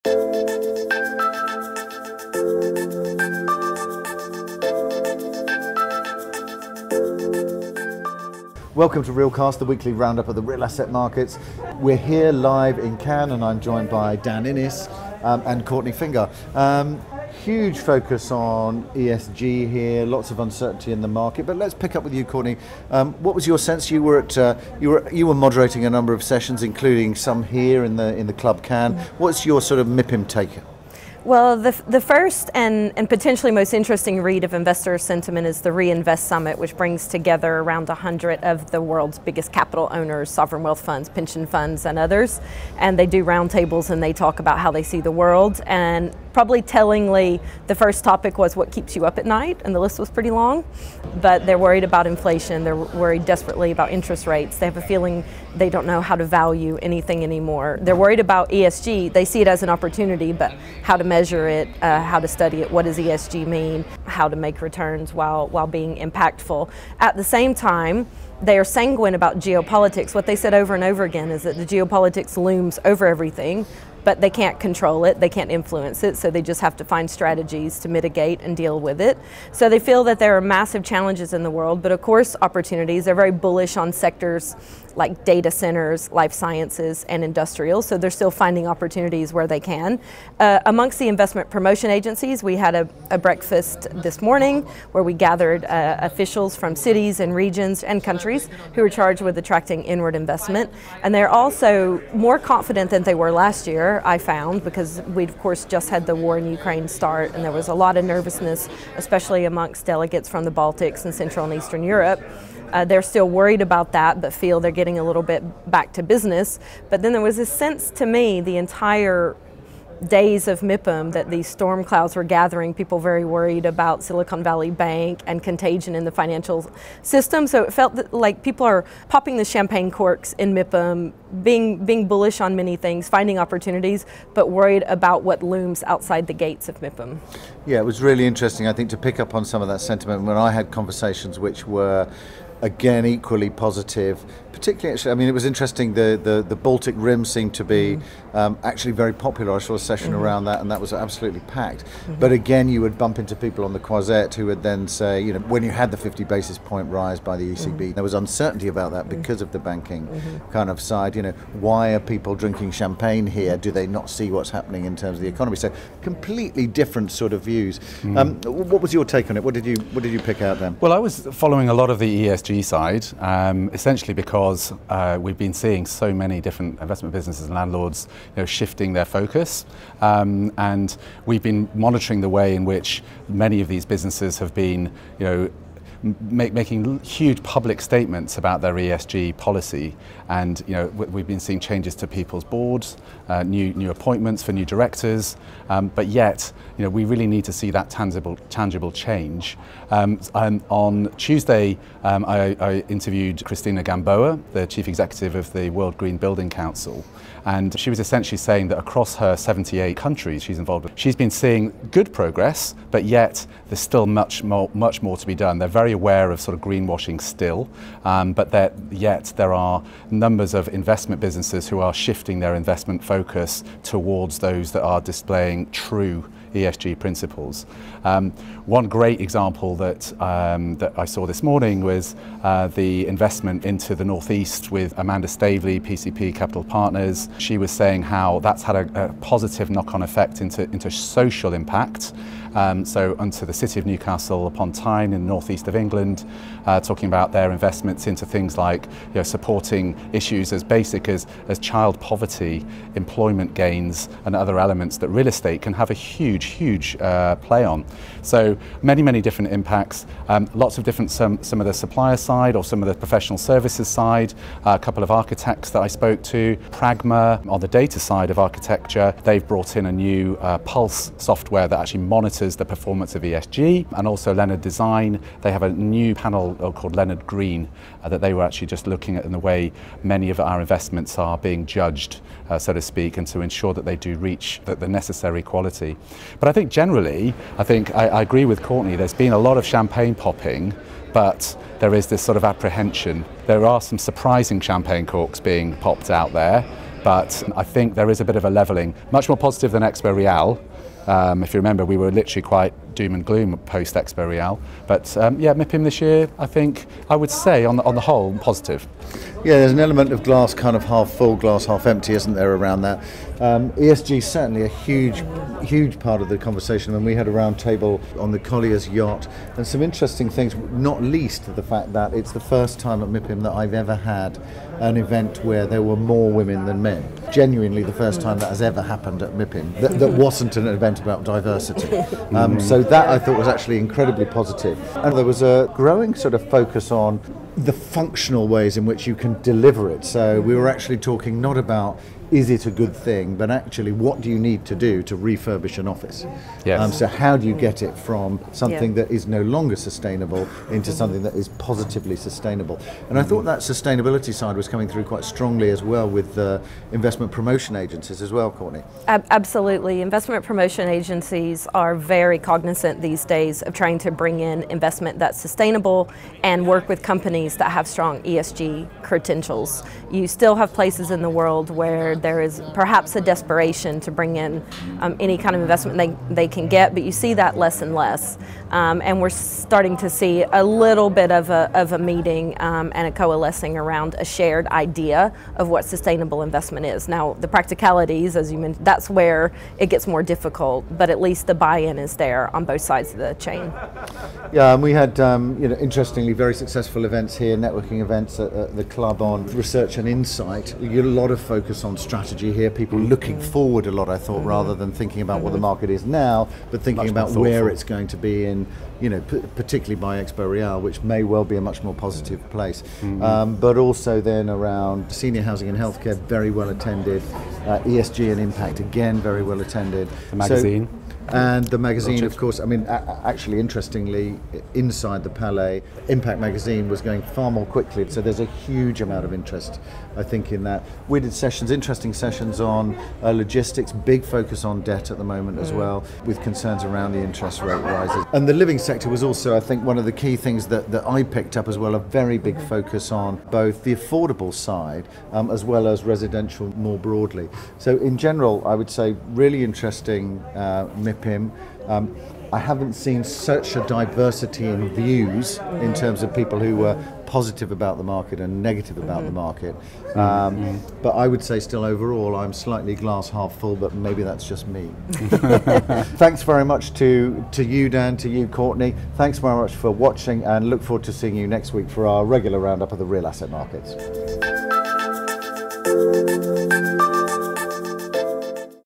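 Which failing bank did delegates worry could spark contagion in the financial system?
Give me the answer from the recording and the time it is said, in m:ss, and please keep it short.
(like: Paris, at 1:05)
Silicon Valley Bank, at 2:04.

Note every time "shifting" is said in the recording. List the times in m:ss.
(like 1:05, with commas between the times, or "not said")
2:58, 3:41.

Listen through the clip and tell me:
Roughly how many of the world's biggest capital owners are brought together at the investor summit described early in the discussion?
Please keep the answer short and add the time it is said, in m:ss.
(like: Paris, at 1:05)
100, at 0:37.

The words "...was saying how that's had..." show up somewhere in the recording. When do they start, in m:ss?
3:57.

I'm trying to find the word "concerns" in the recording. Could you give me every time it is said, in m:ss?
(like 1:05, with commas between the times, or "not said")
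7:16.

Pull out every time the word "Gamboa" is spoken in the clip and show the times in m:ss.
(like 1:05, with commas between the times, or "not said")
3:23.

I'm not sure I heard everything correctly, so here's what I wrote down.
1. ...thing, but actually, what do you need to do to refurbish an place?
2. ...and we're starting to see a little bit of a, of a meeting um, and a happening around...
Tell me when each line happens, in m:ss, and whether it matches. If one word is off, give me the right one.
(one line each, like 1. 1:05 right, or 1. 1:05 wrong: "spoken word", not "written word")
1. 5:42 wrong: "office", not "place"
2. 6:19 wrong: "coalescing", not "happening".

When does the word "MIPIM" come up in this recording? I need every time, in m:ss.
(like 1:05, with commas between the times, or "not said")
0:29, 2:00, 2:10, 2:16, 5:05, 5:23, 5:29, 7:30.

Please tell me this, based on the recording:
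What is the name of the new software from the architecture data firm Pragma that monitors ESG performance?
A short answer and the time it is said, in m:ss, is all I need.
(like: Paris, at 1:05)
Pulse, at 4:30.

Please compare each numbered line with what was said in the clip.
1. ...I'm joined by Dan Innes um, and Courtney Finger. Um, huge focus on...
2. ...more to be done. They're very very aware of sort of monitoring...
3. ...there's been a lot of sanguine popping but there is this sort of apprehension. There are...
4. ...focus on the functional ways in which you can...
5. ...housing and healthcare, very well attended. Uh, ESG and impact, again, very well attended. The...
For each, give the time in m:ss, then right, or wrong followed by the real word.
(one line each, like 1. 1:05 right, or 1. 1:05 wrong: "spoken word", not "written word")
1. 0:13 right
2. 3:35 wrong: "greenwashing", not "monitoring"
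3. 4:48 wrong: "champagne", not "sanguine"
4. 5:36 right
5. 6:55 right.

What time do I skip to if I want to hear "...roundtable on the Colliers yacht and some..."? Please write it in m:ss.
5:17.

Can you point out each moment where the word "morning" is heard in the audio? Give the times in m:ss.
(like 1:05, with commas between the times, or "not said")
1:34, 3:51.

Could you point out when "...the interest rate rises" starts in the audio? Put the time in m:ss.
7:17.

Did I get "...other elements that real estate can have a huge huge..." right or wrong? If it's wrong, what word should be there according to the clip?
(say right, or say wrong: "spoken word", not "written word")
right.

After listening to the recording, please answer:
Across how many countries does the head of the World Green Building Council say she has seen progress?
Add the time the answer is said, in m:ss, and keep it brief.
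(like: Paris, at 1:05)
78, at 3:29.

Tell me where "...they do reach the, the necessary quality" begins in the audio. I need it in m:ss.
4:43.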